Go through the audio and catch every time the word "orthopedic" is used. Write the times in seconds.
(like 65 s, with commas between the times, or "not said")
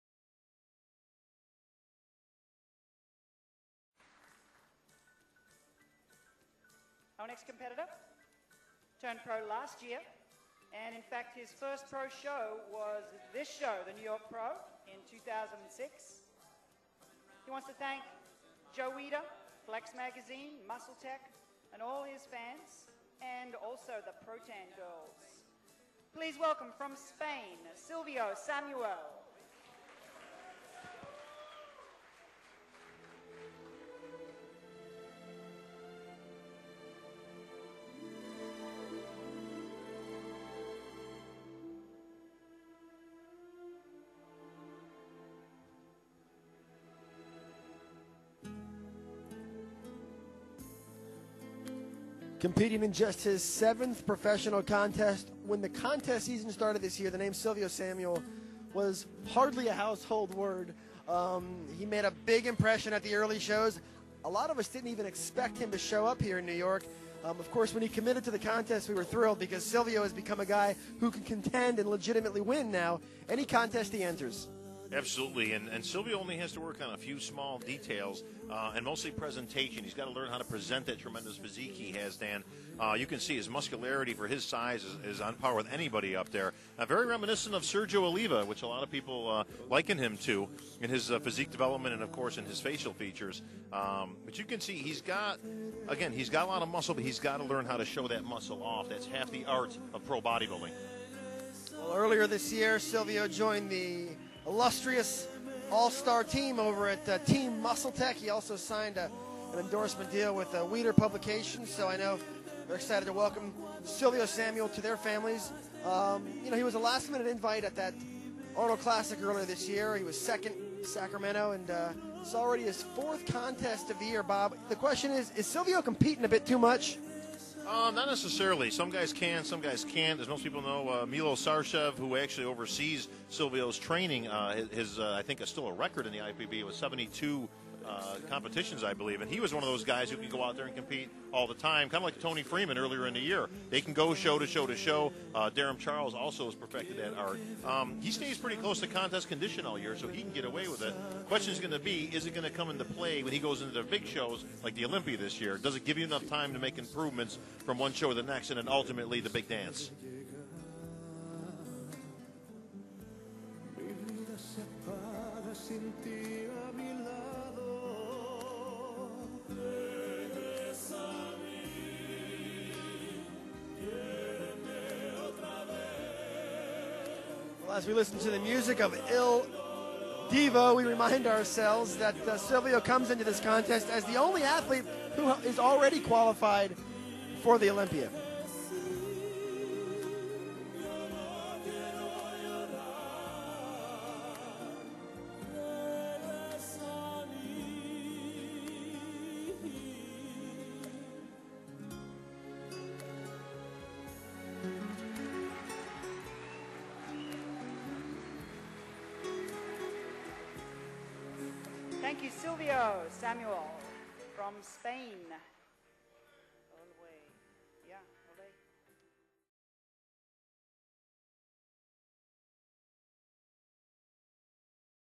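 not said.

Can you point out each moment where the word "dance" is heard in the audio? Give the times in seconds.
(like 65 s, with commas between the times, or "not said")
159 s.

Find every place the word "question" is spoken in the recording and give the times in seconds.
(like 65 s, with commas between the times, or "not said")
124 s, 151 s.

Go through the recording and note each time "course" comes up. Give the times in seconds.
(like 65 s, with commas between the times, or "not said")
67 s, 92 s.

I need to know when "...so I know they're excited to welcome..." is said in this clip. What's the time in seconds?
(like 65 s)
111 s.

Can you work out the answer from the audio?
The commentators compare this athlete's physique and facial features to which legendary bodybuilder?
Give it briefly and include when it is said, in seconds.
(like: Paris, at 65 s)
Sergio Oliva, at 87 s.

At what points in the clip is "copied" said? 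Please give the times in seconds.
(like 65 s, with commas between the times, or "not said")
not said.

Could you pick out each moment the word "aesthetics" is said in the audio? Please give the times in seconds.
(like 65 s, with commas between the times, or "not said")
not said.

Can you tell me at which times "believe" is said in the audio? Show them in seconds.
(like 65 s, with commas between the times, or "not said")
138 s.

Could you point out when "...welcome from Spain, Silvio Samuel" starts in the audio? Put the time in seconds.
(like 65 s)
26 s.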